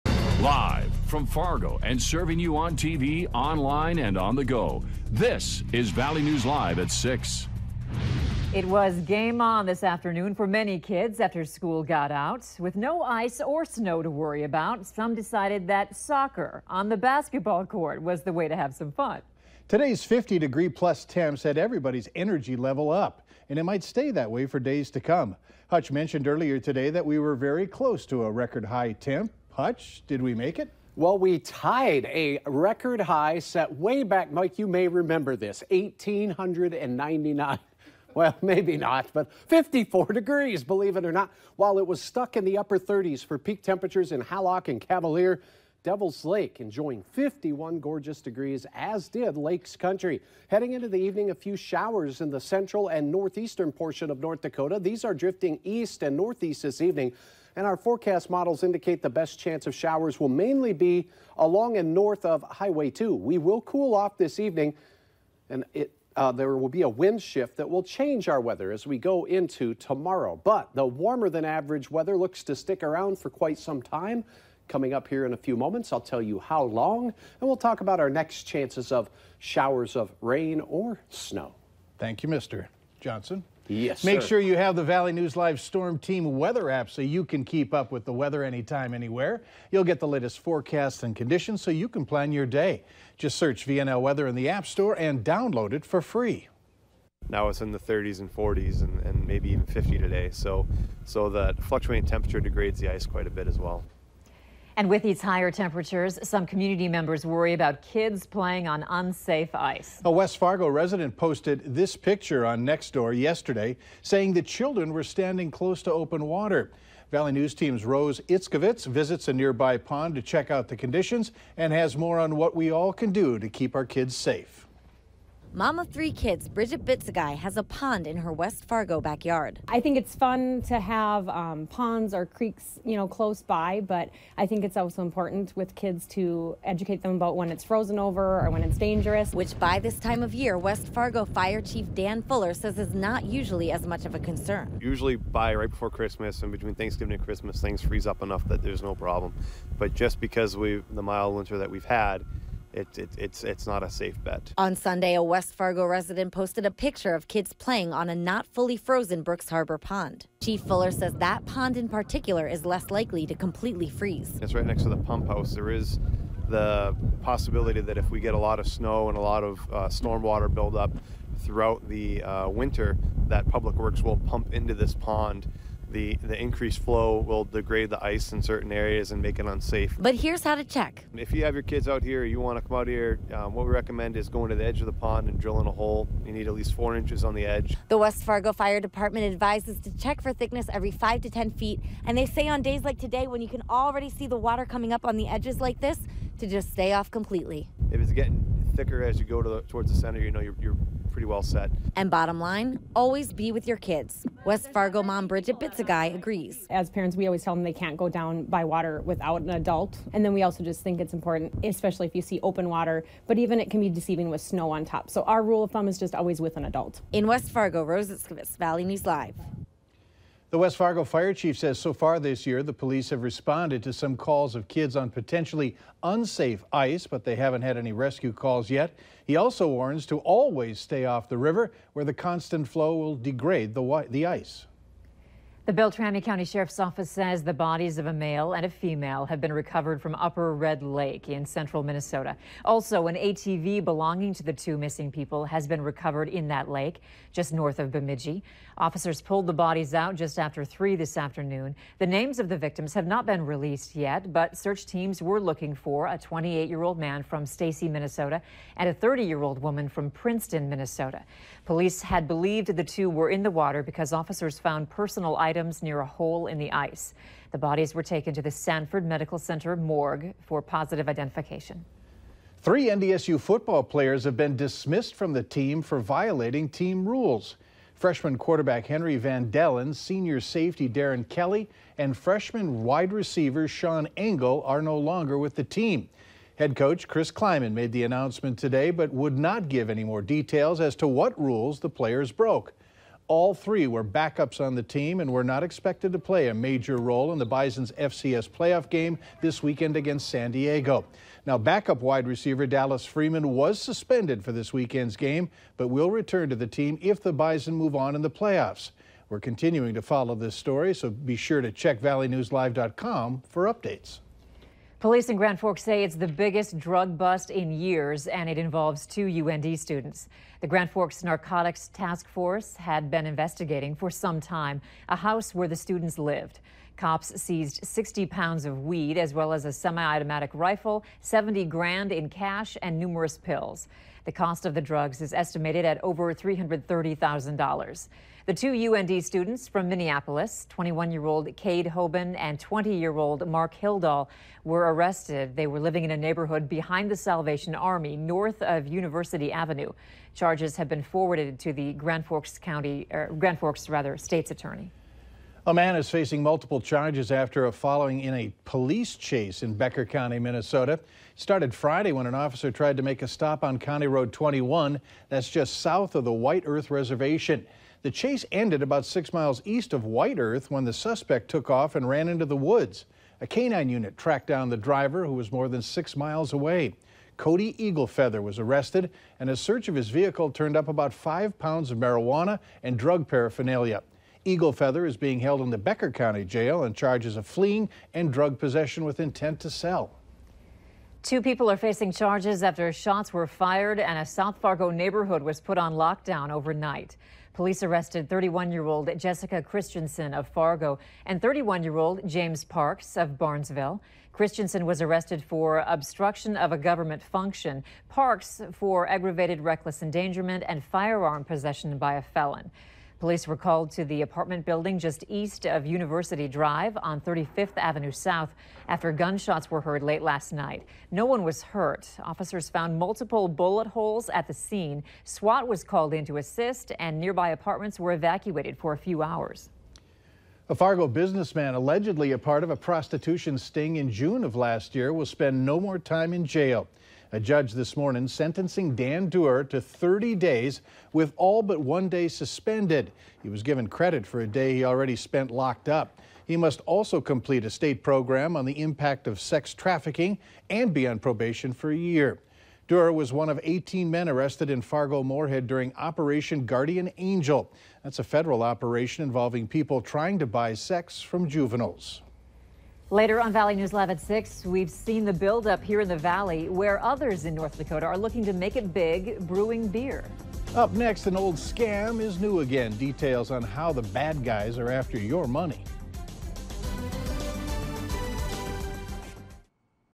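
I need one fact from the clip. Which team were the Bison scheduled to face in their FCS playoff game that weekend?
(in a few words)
San Diego.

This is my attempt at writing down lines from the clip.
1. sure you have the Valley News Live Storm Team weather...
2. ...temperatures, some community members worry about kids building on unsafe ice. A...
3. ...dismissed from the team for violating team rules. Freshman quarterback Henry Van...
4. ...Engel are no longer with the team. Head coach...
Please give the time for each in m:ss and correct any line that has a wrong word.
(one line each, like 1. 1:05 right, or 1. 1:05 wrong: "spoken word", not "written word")
1. 1:24 right
2. 1:45 wrong: "playing", not "building"
3. 4:34 right
4. 4:44 right.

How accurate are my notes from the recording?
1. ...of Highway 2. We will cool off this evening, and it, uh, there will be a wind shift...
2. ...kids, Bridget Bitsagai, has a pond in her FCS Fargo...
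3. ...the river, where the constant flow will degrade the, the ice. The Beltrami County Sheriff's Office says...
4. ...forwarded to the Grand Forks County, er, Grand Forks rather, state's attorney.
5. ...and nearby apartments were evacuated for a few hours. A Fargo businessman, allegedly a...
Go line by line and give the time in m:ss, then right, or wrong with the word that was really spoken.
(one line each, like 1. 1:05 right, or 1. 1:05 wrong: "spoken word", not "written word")
1. 1:02 right
2. 2:06 wrong: "West", not "FCS"
3. 3:51 right
4. 5:51 right
5. 7:06 right.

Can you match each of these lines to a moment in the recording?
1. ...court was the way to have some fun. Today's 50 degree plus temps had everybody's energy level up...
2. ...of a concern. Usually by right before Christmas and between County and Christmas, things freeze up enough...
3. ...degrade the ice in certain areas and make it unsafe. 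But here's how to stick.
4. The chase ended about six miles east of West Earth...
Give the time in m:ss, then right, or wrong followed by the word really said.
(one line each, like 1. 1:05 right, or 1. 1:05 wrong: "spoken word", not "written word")
1. 0:17 right
2. 2:24 wrong: "Thanksgiving", not "County"
3. 2:57 wrong: "check", not "stick"
4. 6:08 wrong: "White", not "West".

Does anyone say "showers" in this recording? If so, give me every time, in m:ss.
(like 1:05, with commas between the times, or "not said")
0:51, 0:59, 1:19.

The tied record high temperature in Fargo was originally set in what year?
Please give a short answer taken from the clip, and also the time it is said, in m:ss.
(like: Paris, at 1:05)
1899, at 0:35.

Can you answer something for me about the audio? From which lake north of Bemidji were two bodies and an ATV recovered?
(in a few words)
Upper Red Lake.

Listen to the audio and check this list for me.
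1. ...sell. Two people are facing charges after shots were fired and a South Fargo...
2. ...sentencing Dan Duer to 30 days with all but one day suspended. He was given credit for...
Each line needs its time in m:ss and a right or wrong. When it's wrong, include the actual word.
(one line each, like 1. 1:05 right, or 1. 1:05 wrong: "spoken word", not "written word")
1. 6:29 right
2. 7:18 right.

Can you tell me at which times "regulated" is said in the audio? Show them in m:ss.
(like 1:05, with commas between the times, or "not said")
not said.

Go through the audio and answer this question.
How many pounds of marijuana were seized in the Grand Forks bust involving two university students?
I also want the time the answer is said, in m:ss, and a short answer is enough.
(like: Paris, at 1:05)
60, at 5:27.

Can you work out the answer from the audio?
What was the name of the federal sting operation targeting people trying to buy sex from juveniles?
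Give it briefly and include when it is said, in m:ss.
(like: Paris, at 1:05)
Operation Guardian Angel, at 7:35.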